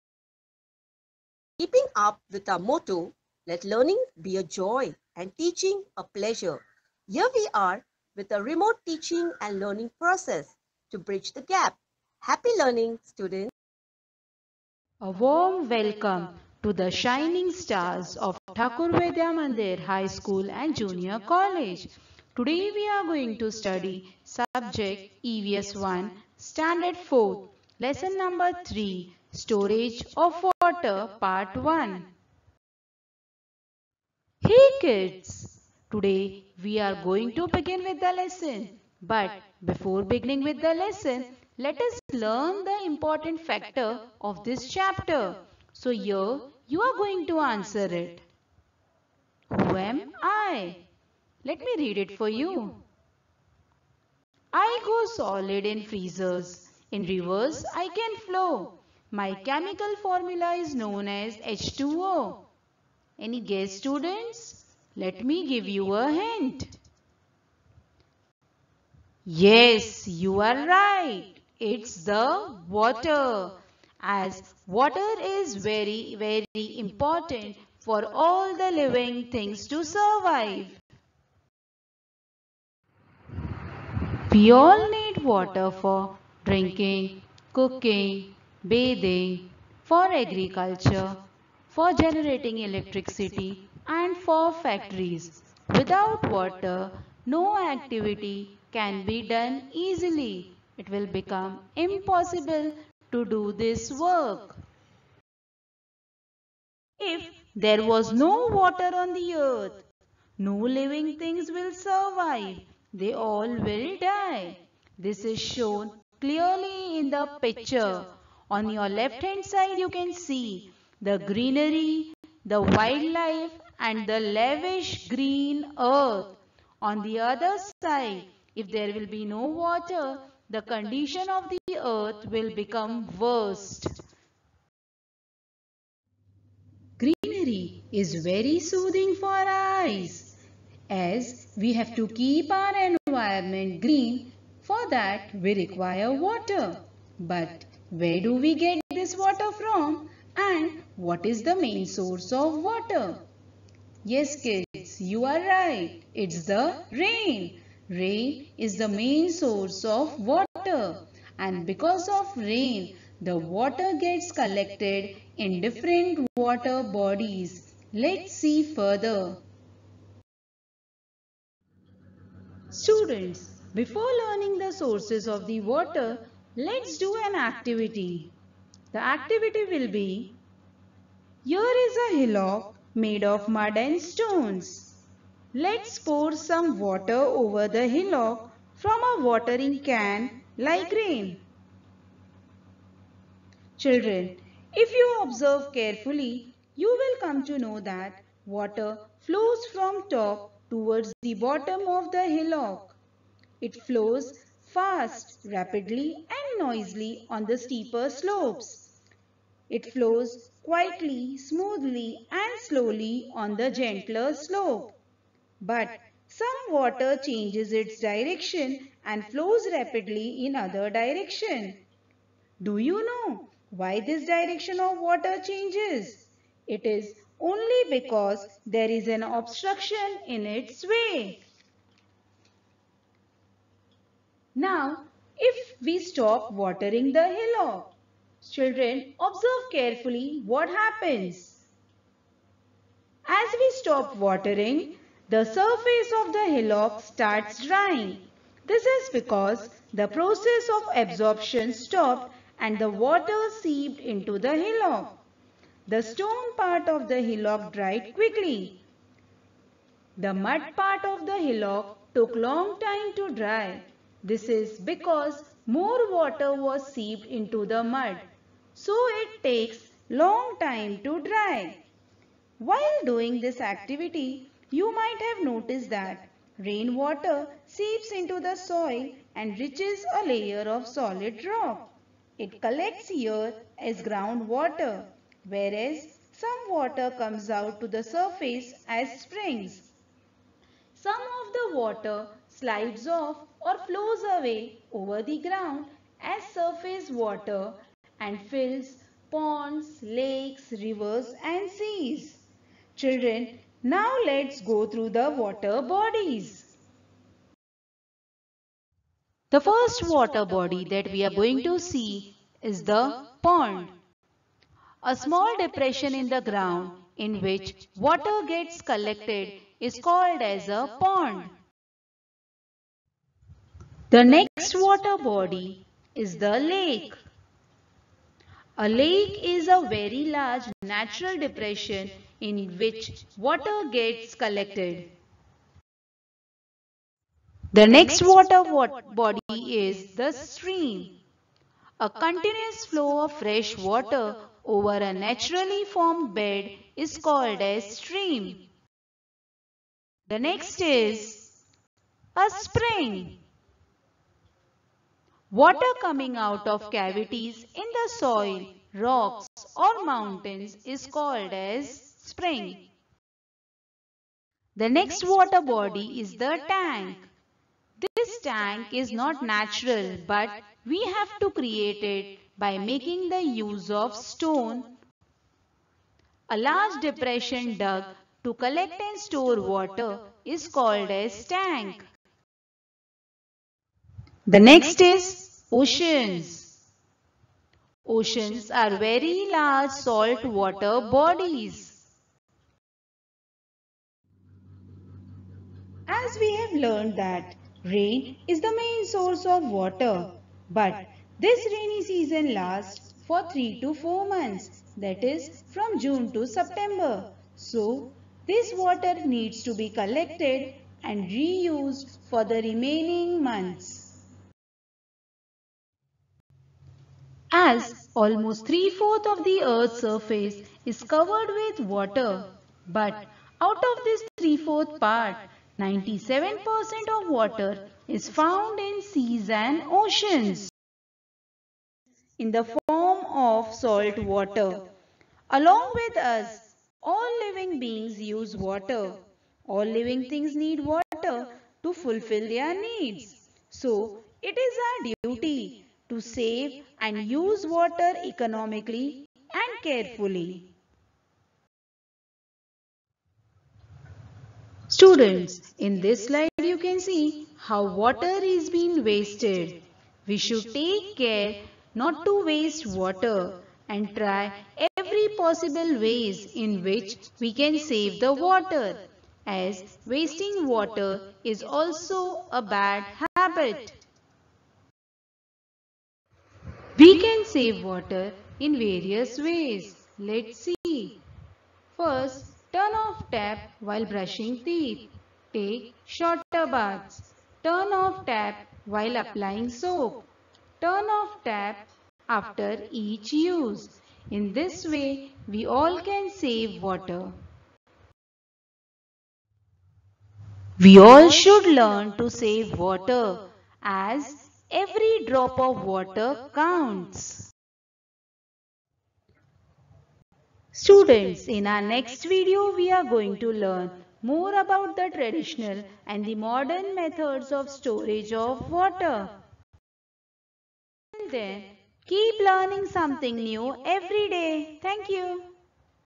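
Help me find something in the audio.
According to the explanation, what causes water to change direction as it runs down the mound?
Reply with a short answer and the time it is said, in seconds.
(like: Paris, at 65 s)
an obstruction, at 229 s.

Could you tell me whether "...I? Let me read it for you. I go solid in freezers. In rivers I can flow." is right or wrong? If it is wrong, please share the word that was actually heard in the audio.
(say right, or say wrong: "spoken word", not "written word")
right.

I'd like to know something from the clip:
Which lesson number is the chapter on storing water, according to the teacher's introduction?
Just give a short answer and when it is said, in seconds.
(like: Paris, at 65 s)
3, at 27 s.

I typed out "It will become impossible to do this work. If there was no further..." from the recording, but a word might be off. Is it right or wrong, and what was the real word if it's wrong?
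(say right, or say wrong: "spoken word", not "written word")
wrong: "water", not "further".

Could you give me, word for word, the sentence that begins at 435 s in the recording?
Along with us, all living beings use water.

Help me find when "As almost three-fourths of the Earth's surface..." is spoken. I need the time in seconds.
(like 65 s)
417 s.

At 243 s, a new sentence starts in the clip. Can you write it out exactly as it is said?
As we stop watering, the surface of the hillock starts drying.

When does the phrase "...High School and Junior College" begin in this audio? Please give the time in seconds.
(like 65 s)
19 s.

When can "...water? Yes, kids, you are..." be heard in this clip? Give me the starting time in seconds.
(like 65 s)
152 s.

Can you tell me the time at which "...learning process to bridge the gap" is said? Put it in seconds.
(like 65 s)
9 s.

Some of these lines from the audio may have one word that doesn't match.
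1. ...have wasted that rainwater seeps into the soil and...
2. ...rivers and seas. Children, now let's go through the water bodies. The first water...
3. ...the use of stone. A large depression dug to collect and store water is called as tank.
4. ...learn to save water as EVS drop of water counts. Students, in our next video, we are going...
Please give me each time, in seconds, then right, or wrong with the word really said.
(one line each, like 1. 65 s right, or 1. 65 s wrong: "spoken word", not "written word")
1. 275 s wrong: "noticed", not "wasted"
2. 300 s right
3. 373 s right
4. 501 s wrong: "Every", not "EVS".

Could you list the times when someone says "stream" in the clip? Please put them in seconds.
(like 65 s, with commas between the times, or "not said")
340 s, 347 s.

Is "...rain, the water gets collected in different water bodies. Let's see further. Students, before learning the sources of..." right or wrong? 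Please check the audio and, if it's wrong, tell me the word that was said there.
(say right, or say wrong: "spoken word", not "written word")
right.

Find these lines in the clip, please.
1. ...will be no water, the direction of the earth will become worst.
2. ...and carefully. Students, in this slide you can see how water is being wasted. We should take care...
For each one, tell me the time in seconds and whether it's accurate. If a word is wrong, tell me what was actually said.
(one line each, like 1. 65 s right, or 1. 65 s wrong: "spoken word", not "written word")
1. 128 s wrong: "condition", not "direction"
2. 449 s right.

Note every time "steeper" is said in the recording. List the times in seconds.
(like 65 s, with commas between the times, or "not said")
207 s.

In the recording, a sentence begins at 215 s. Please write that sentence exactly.
But some water changes its direction and flows rapidly in other direction.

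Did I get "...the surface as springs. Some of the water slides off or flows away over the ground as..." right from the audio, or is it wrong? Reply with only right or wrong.
right.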